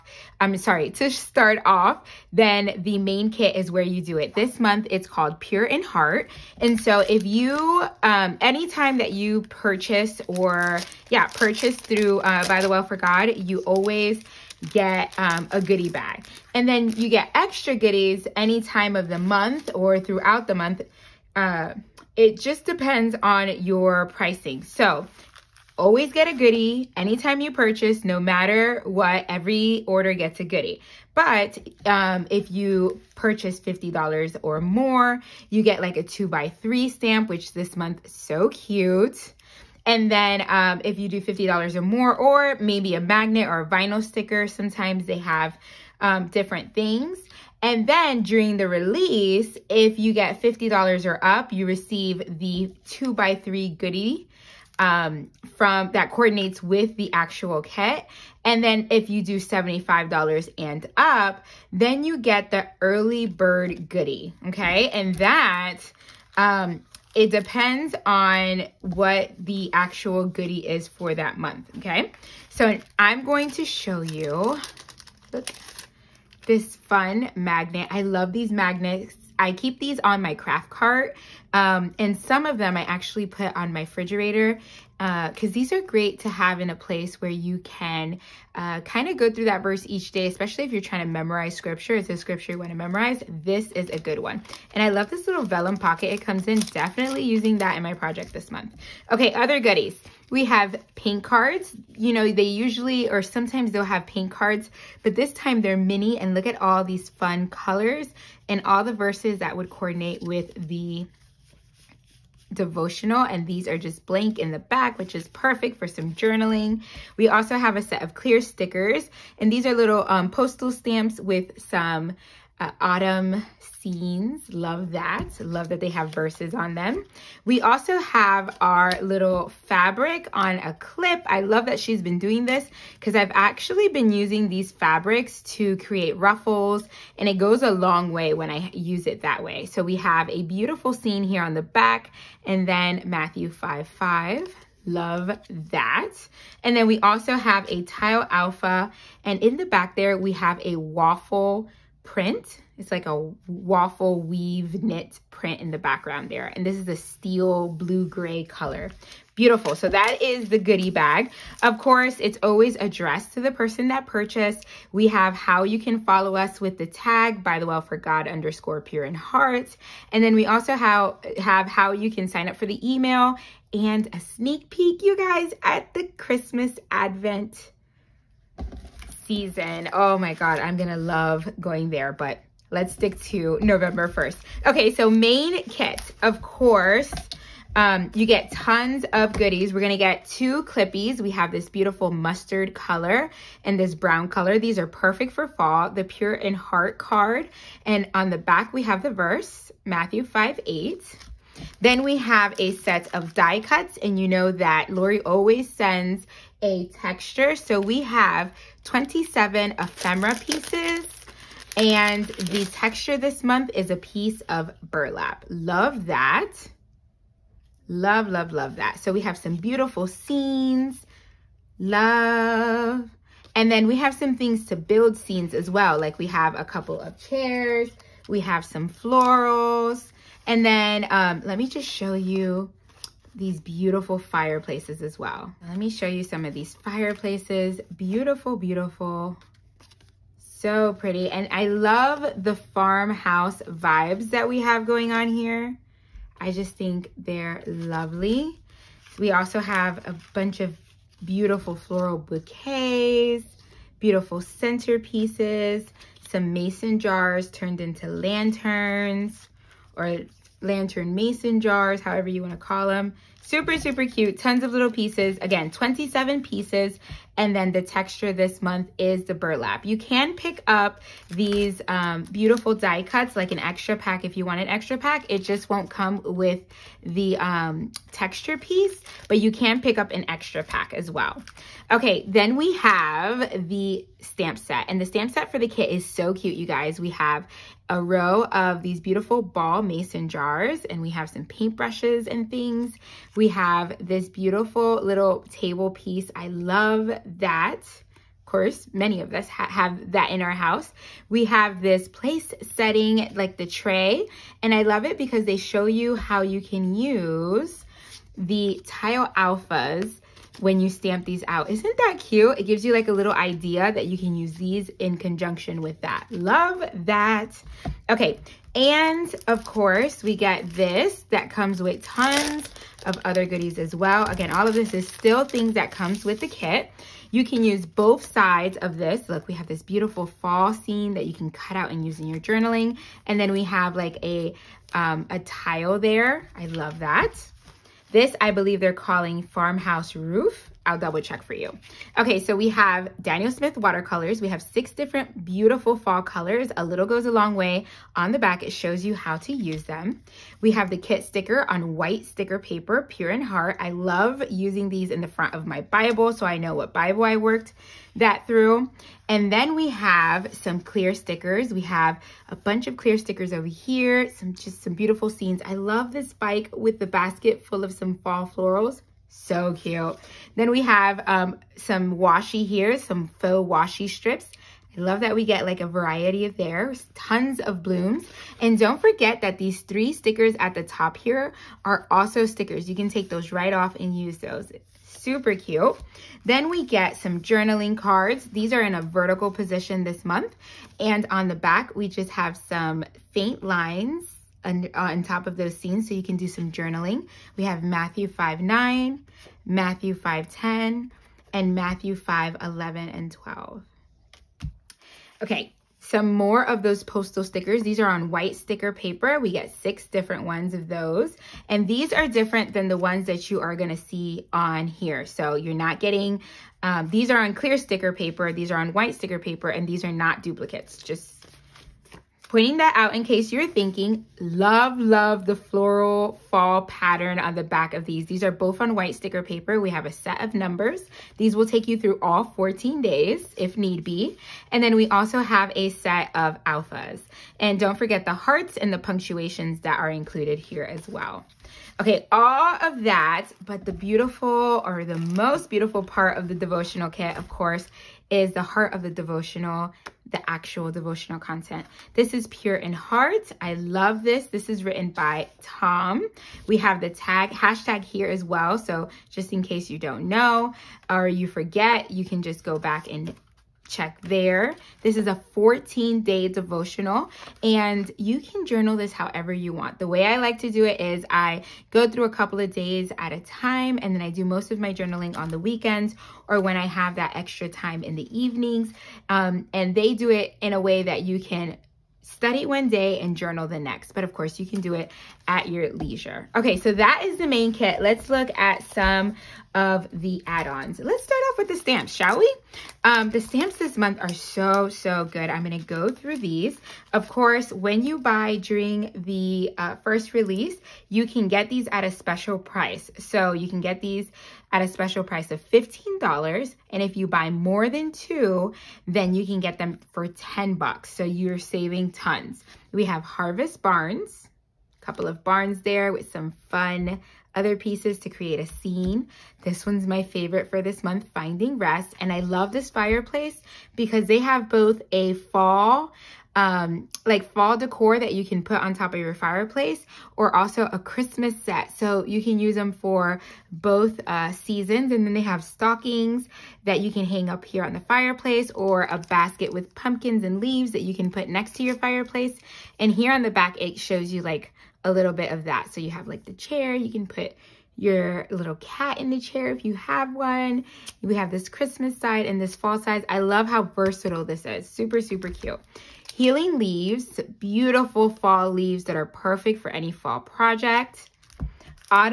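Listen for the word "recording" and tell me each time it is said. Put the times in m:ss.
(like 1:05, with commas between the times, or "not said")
not said.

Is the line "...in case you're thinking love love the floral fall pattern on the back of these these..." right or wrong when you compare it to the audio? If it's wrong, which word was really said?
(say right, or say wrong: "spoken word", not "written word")
right.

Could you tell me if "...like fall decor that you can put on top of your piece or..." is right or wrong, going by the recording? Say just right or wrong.
wrong.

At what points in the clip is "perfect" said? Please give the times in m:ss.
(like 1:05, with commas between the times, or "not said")
1:55, 3:14, 9:19.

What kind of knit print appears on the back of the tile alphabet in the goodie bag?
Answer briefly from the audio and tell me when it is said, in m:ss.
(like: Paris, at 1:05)
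waffle weave, at 2:33.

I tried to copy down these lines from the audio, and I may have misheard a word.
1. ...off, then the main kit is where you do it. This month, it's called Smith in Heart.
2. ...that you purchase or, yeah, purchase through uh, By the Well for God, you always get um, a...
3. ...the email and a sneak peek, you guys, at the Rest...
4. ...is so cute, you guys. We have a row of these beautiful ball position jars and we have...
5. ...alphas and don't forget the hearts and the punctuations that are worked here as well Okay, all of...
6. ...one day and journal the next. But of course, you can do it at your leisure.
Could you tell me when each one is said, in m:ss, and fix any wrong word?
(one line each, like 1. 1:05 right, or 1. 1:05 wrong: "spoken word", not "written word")
1. 0:01 wrong: "Pure", not "Smith"
2. 0:08 right
3. 2:52 wrong: "Christmas", not "Rest"
4. 4:45 wrong: "mason", not "position"
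5. 7:16 wrong: "included", not "worked"
6. 8:02 right.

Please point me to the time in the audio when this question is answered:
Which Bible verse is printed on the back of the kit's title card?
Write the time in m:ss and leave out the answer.
3:19.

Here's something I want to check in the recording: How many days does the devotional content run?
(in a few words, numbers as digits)
14.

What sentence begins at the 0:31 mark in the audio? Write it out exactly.
But um, if you purchase $50 or more, you get like a two by three stamp, which this month, so cute.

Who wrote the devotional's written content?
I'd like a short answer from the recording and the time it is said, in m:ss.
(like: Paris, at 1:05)
Tom, at 7:35.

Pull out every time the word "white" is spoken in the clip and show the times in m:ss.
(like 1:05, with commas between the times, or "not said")
5:51, 6:48, 6:58, 7:08.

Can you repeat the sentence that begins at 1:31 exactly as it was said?
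It's a scripture you want to memorize.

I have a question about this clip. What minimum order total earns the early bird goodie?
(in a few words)
$75.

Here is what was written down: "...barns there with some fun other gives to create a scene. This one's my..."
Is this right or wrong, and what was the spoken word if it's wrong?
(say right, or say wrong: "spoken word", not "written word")
wrong: "pieces", not "gives".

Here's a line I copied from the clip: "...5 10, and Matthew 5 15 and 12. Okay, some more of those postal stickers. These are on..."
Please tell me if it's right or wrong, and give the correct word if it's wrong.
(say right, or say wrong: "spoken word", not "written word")
wrong: "11", not "15".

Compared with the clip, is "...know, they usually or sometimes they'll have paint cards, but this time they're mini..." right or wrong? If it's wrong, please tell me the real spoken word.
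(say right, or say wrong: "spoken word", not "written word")
right.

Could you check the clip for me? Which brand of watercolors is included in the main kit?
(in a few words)
Daniel Smith.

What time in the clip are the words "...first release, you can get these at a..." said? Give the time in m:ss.
8:20.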